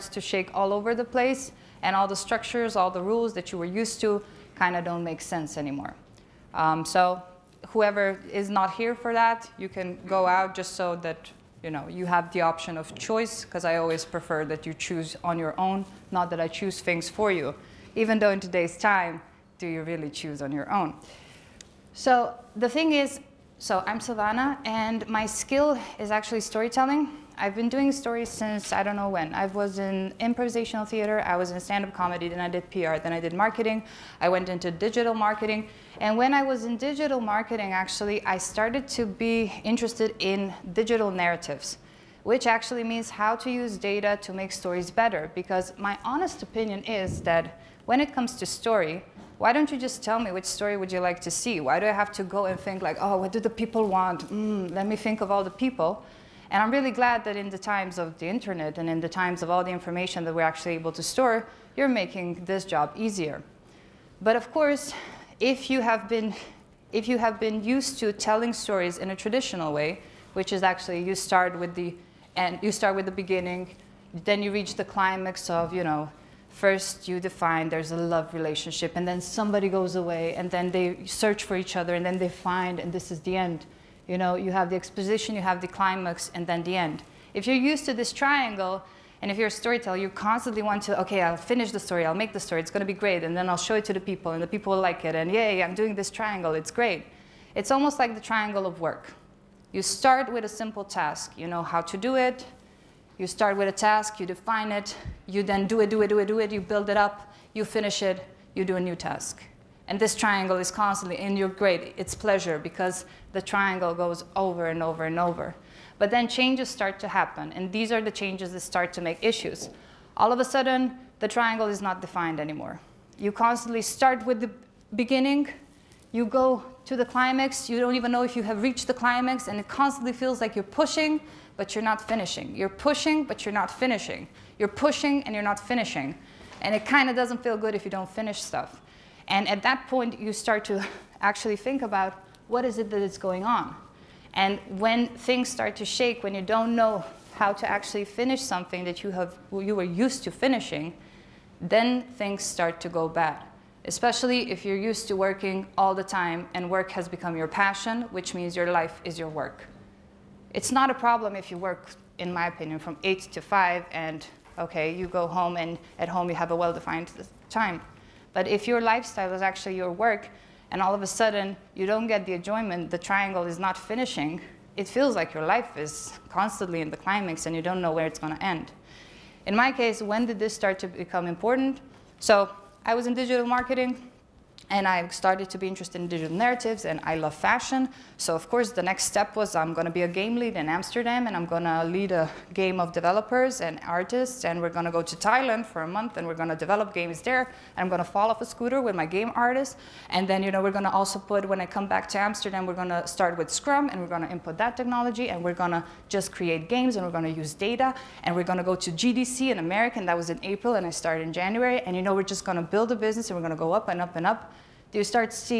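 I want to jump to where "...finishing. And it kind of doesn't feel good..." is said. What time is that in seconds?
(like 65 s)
135 s.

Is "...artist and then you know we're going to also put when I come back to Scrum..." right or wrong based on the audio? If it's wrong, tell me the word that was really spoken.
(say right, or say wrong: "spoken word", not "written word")
wrong: "Amsterdam", not "Scrum".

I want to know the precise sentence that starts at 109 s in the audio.
And this triangle is constantly in your grade.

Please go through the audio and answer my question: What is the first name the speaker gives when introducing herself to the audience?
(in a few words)
Silvana.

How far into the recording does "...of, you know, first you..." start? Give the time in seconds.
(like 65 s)
75 s.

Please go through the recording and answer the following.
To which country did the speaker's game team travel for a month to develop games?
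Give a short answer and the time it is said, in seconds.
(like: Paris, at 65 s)
Thailand, at 195 s.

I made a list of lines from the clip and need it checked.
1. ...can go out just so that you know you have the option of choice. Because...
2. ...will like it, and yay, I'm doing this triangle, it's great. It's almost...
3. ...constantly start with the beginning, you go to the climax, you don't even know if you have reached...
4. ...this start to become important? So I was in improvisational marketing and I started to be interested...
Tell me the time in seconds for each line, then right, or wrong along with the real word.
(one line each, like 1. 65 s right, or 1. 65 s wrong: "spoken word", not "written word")
1. 9 s right
2. 94 s right
3. 123 s right
4. 180 s wrong: "digital", not "improvisational".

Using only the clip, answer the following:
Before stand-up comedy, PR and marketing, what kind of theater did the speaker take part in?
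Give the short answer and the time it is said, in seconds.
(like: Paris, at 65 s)
Improvisational theater, at 30 s.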